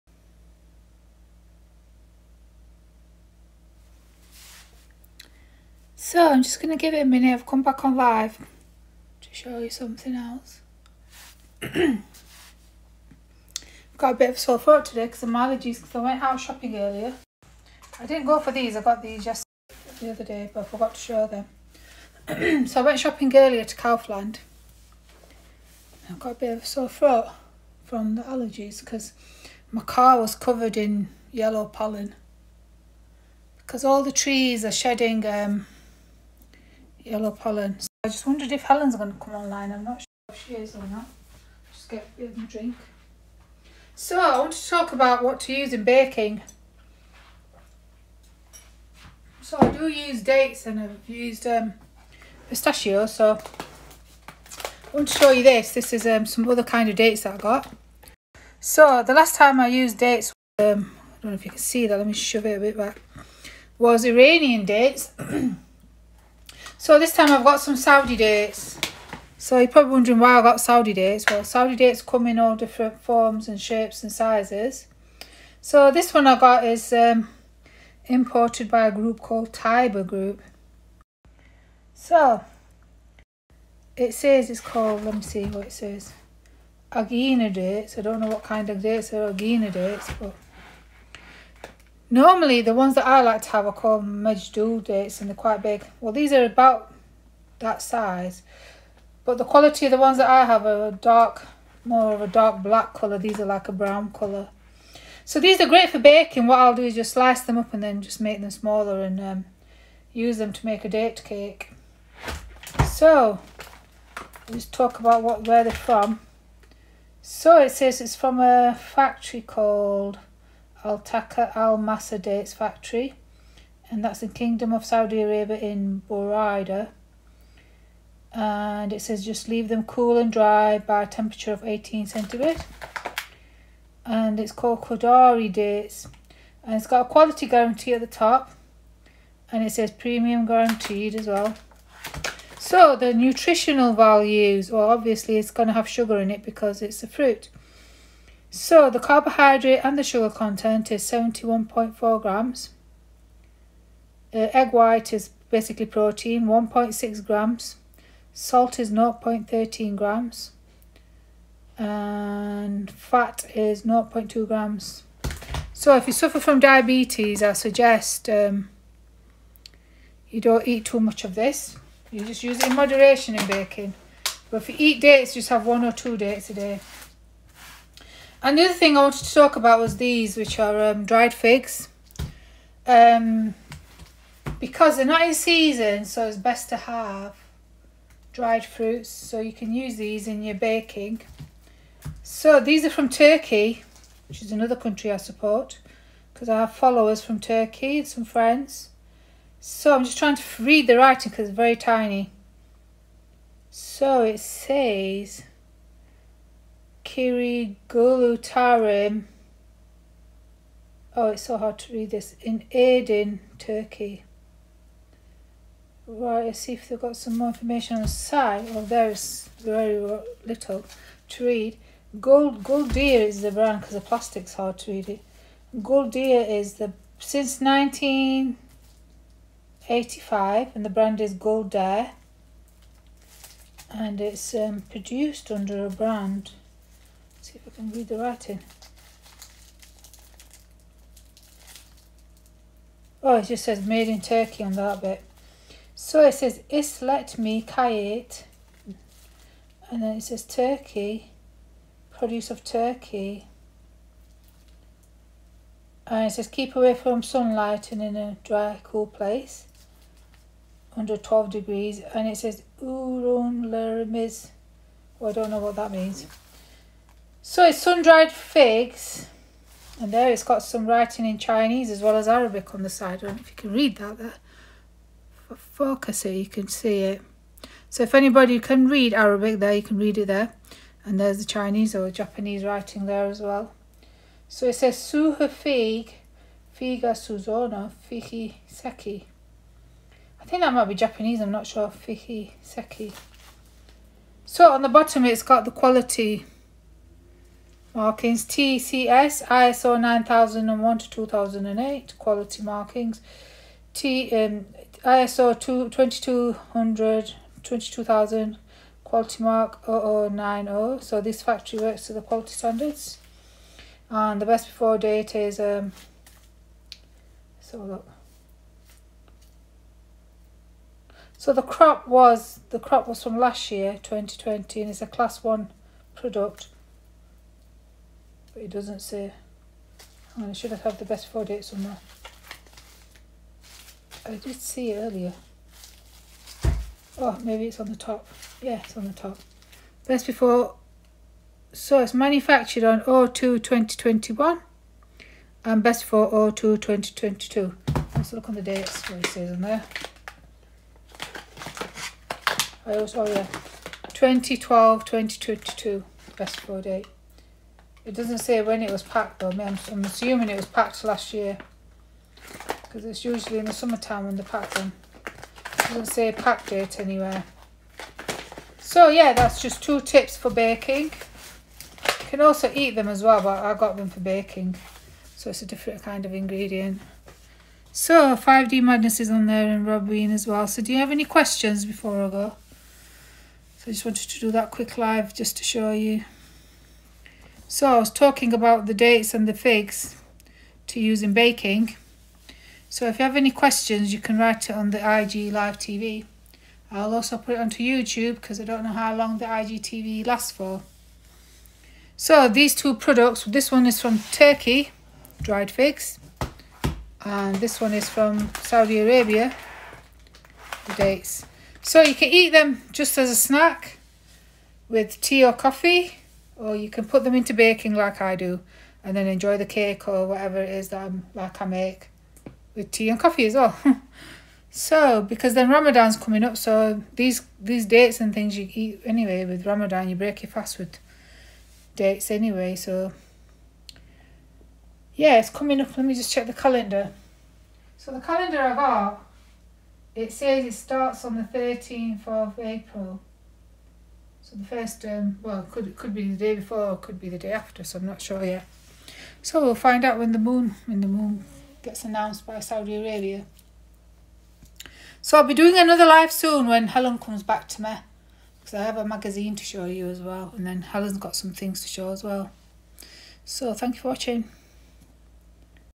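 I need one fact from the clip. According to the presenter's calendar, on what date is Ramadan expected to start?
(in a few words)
13 April.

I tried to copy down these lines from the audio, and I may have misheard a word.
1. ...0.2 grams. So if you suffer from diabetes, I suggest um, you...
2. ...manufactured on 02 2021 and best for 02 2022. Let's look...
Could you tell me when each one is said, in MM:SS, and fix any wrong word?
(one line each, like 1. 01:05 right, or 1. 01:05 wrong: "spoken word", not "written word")
1. 02:44 right
2. 05:42 right.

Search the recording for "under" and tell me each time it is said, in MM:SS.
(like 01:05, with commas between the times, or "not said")
03:55, 04:20.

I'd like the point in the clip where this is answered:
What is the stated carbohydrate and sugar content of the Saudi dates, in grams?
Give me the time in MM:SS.
02:31.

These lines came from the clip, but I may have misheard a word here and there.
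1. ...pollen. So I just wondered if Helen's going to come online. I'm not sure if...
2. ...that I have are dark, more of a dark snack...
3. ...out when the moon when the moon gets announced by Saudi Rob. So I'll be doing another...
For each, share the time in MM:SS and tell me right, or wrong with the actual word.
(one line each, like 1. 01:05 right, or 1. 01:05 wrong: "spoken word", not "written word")
1. 00:37 right
2. 01:40 wrong: "black", not "snack"
3. 07:30 wrong: "Arabia", not "Rob".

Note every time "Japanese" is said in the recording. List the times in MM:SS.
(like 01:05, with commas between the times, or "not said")
04:42, 04:50.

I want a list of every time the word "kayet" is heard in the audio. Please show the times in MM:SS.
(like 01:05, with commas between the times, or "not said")
04:07.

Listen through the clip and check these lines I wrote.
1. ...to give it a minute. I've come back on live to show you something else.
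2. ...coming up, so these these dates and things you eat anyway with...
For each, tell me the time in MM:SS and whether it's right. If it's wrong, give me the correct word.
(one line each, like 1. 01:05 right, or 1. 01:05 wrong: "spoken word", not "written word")
1. 00:06 right
2. 07:06 right.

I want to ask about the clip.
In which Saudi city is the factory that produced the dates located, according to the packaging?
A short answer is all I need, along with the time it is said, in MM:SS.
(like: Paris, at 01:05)
Buraida, at 02:06.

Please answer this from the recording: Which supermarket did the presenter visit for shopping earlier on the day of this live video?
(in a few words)
Kaufland.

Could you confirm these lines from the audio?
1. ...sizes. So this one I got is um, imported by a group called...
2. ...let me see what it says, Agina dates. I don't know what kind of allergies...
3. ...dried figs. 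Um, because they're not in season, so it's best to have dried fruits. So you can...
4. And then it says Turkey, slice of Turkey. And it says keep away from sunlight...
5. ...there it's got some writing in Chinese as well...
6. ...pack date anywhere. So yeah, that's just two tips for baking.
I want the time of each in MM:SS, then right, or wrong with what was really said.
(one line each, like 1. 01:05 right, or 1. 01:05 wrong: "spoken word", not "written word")
1. 01:14 right
2. 01:25 wrong: "dates", not "allergies"
3. 03:01 right
4. 04:09 wrong: "produce", not "slice"
5. 04:30 right
6. 06:06 right.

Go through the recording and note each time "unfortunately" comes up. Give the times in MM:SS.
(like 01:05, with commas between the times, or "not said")
not said.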